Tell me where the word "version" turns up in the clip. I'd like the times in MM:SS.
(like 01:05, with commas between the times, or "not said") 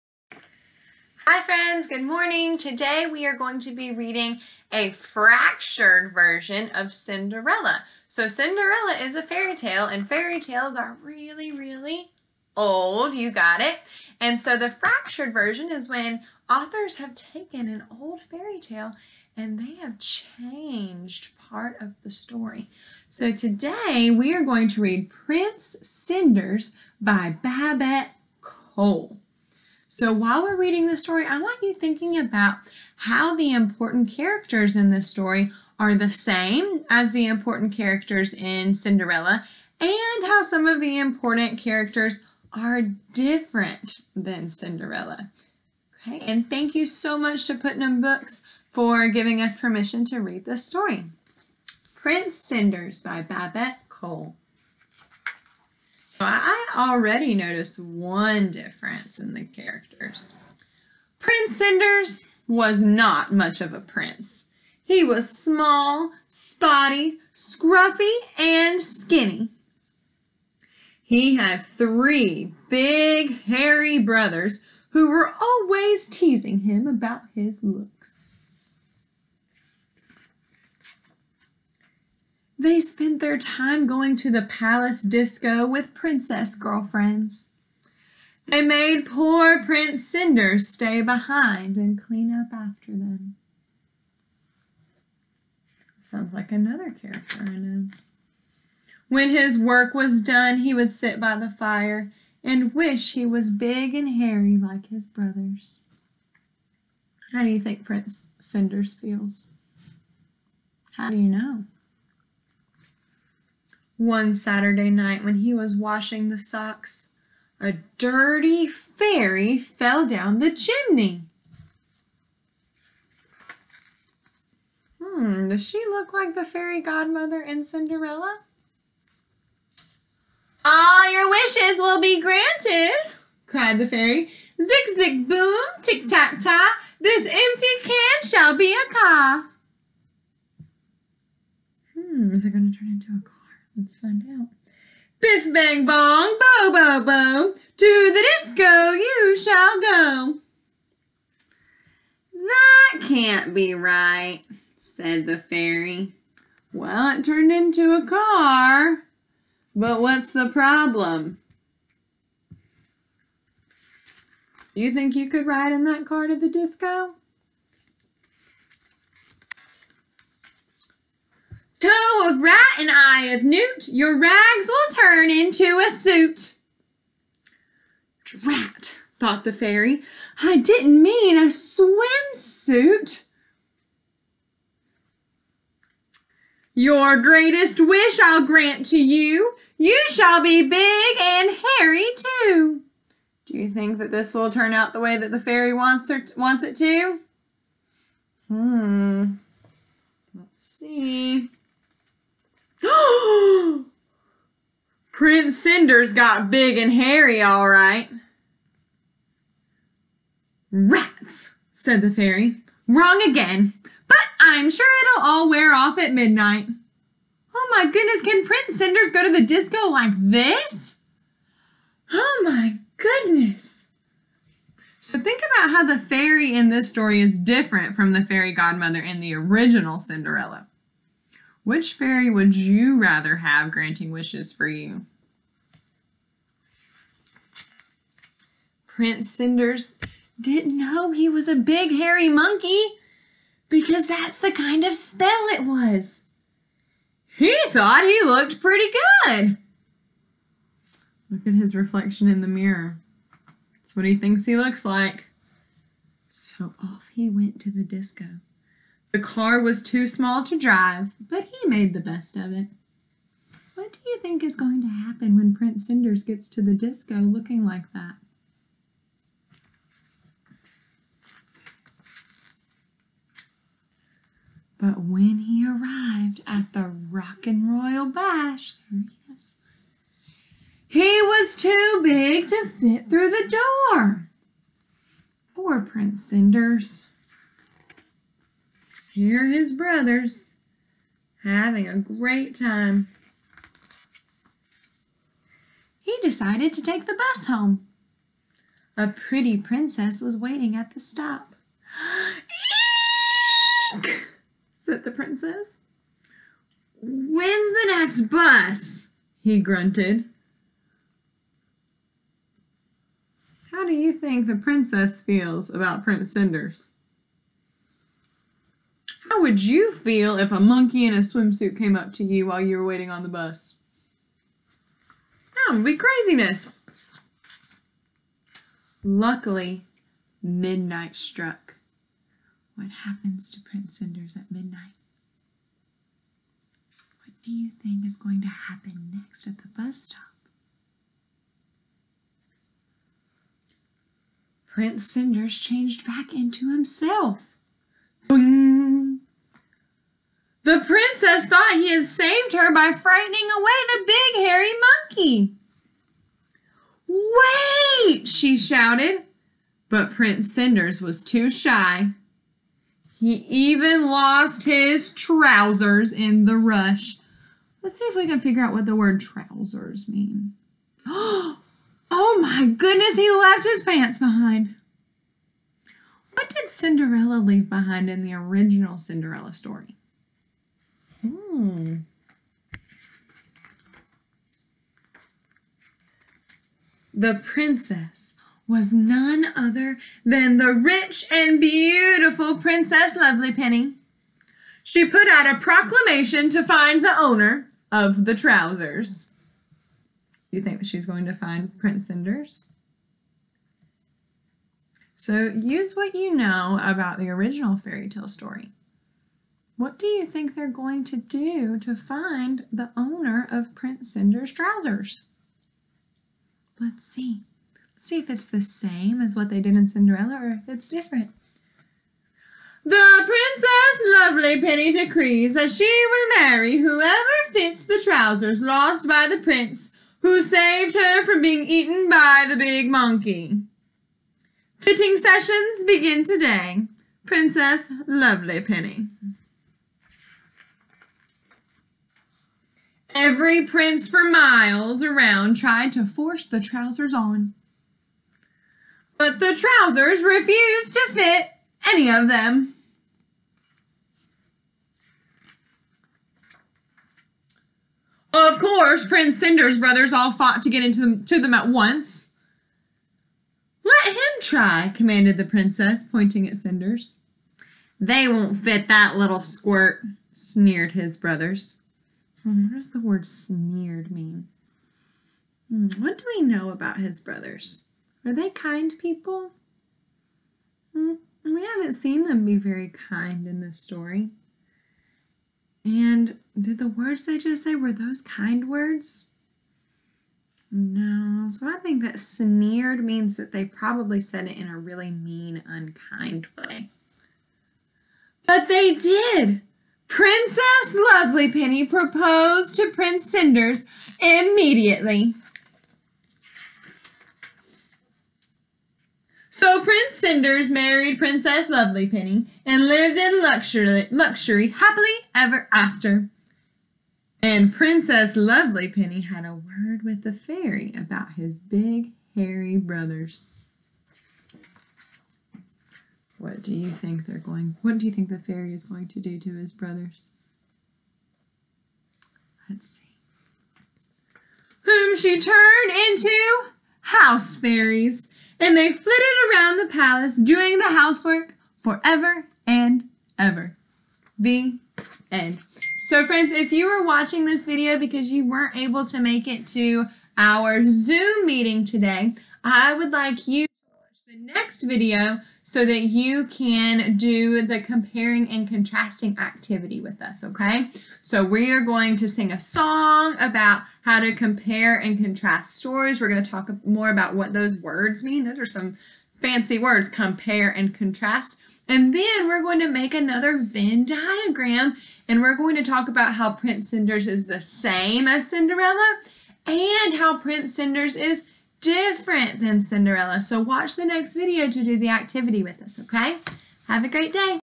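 00:06, 00:15.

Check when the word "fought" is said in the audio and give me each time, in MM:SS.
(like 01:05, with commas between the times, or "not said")
07:40.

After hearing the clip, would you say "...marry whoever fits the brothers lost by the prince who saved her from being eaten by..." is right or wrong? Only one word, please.
wrong.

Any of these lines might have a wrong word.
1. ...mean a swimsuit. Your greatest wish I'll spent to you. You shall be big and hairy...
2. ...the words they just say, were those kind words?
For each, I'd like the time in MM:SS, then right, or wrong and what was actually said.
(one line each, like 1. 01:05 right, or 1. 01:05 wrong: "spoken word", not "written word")
1. 03:01 wrong: "grant", not "spent"
2. 08:06 right.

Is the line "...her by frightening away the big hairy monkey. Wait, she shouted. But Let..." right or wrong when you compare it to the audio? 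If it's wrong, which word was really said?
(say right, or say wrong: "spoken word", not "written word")
wrong: "Prince", not "Let".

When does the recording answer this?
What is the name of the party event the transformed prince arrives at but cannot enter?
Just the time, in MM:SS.
04:37.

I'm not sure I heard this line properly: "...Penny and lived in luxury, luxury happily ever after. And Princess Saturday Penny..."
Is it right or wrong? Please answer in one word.
wrong.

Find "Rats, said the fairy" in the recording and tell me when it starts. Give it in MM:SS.
03:30.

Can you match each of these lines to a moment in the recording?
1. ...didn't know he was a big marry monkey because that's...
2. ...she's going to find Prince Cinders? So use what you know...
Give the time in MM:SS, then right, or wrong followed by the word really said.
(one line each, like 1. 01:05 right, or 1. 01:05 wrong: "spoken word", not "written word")
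1. 04:00 wrong: "hairy", not "marry"
2. 06:40 right.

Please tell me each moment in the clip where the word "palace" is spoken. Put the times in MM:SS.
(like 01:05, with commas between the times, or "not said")
01:24, 08:59.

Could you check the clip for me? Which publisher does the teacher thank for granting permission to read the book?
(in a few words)
Putnam Books.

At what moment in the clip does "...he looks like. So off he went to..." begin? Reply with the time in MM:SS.
04:14.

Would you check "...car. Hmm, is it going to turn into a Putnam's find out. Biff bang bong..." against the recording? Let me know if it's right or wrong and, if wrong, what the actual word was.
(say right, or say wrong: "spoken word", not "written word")
wrong: "Let", not "Putnam".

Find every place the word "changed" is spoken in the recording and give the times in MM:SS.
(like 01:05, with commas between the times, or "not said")
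00:19, 05:45.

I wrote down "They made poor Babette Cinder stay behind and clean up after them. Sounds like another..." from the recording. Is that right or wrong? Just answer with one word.
wrong.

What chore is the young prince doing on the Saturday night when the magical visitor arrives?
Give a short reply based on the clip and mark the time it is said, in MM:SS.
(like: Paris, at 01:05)
washing the socks, at 01:55.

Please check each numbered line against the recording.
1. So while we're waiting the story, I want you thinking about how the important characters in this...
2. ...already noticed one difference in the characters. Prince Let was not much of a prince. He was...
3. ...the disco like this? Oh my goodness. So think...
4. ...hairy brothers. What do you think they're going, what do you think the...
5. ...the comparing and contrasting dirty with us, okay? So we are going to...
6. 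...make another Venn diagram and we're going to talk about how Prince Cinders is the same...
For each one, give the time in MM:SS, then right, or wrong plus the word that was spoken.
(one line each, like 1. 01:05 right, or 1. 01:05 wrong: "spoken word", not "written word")
1. 00:29 wrong: "reading", not "waiting"
2. 00:56 wrong: "Cinders", not "Let"
3. 03:39 right
4. 08:42 right
5. 09:17 wrong: "activity", not "dirty"
6. 09:32 right.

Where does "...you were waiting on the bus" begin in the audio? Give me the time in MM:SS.
05:22.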